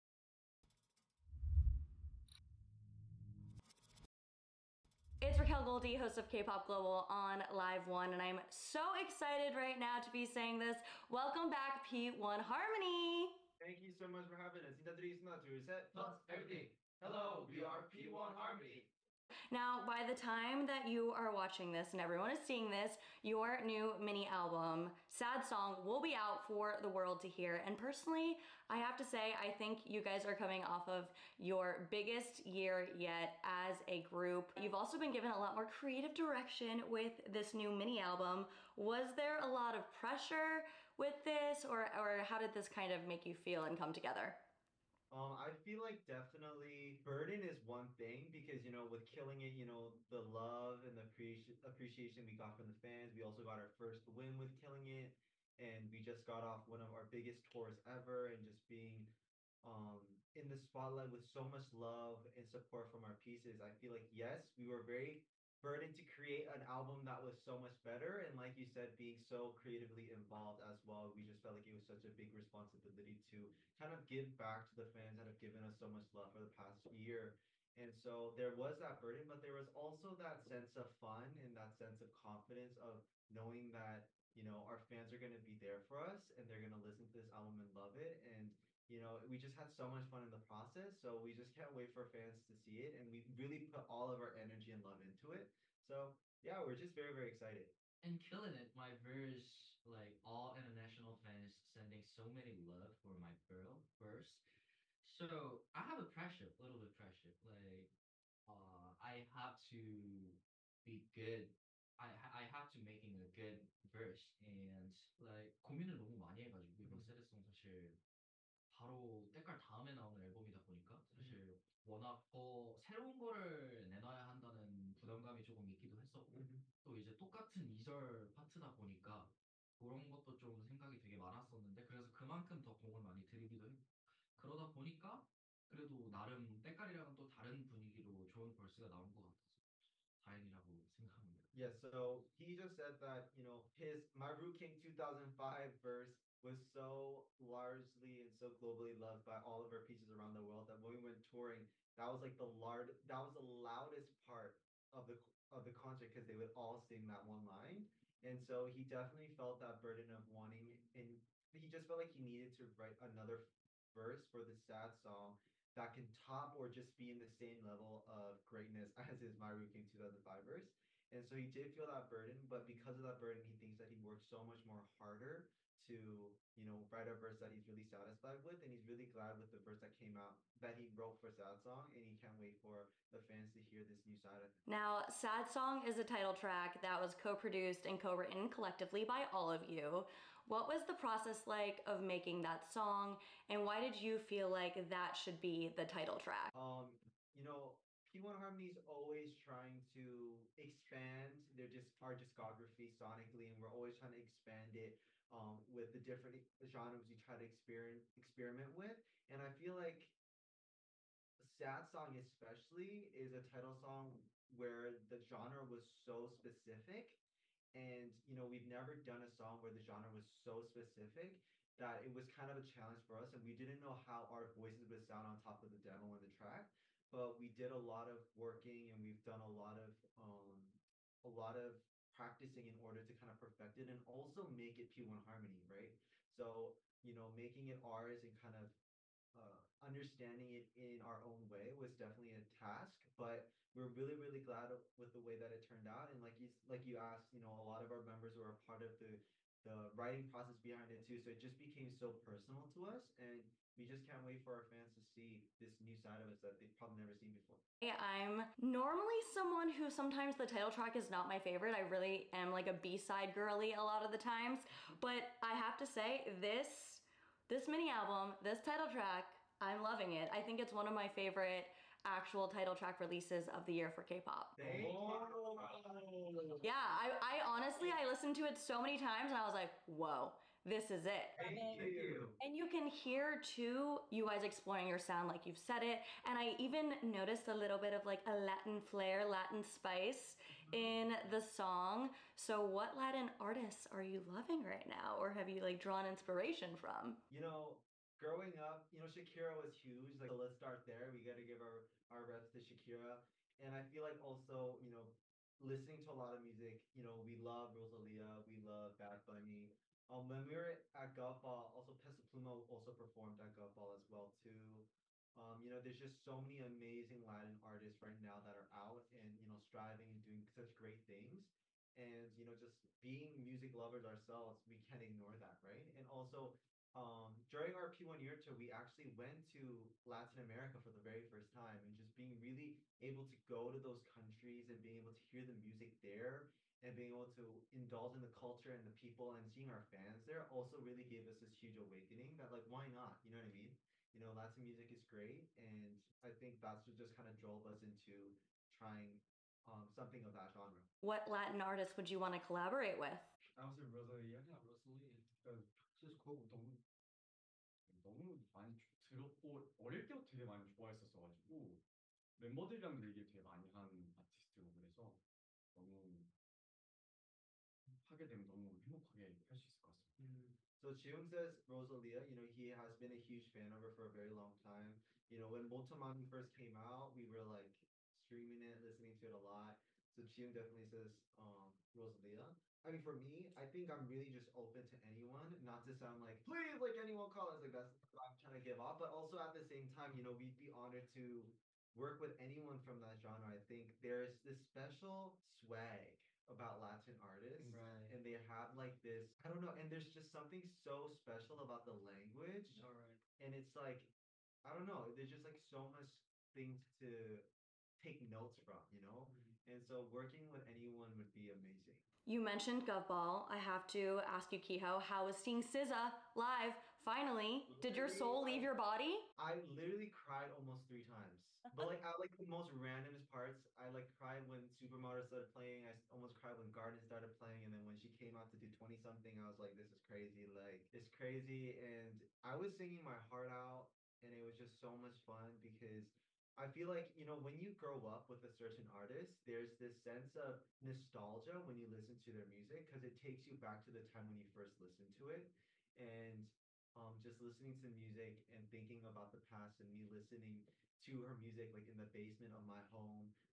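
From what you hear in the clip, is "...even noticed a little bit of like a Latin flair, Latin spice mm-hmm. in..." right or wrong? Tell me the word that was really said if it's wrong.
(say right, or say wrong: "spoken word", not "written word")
right.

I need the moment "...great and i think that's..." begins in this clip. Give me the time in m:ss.
5:45.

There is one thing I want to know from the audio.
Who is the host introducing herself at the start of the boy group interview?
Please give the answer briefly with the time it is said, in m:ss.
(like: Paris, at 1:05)
Racquel Goldy, at 0:05.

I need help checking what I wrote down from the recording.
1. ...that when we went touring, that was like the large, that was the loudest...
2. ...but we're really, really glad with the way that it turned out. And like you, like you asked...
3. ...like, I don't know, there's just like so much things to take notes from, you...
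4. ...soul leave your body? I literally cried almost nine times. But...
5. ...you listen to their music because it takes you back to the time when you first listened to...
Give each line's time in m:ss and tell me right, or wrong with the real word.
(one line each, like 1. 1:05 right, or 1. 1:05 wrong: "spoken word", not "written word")
1. 2:30 right
2. 4:03 right
3. 6:43 right
4. 6:58 wrong: "three", not "nine"
5. 7:21 right.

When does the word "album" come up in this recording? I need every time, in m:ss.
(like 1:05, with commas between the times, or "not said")
0:24, 0:37, 1:06, 1:27, 4:27.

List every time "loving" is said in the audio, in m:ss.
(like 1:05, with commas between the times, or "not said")
4:29, 4:54.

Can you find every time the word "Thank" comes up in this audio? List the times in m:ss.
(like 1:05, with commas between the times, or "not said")
0:13, 4:41.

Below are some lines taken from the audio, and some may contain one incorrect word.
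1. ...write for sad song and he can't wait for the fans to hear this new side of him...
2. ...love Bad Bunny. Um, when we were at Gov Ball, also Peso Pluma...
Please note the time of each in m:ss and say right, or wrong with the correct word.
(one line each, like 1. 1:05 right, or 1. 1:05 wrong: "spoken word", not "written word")
1. 3:00 wrong: "wrote", not "write"
2. 5:08 right.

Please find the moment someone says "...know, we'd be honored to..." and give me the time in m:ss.
6:30.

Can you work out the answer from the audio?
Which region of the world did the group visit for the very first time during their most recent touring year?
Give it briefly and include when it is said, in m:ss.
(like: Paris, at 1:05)
Latin America, at 5:30.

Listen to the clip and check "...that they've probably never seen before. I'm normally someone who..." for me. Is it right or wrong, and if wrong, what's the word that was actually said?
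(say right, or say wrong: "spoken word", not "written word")
right.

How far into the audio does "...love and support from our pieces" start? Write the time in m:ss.
1:01.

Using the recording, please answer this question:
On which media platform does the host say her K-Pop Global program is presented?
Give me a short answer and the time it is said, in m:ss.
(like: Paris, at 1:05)
Live One, at 0:07.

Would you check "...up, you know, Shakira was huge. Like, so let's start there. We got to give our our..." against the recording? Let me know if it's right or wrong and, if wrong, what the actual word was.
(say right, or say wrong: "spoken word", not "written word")
right.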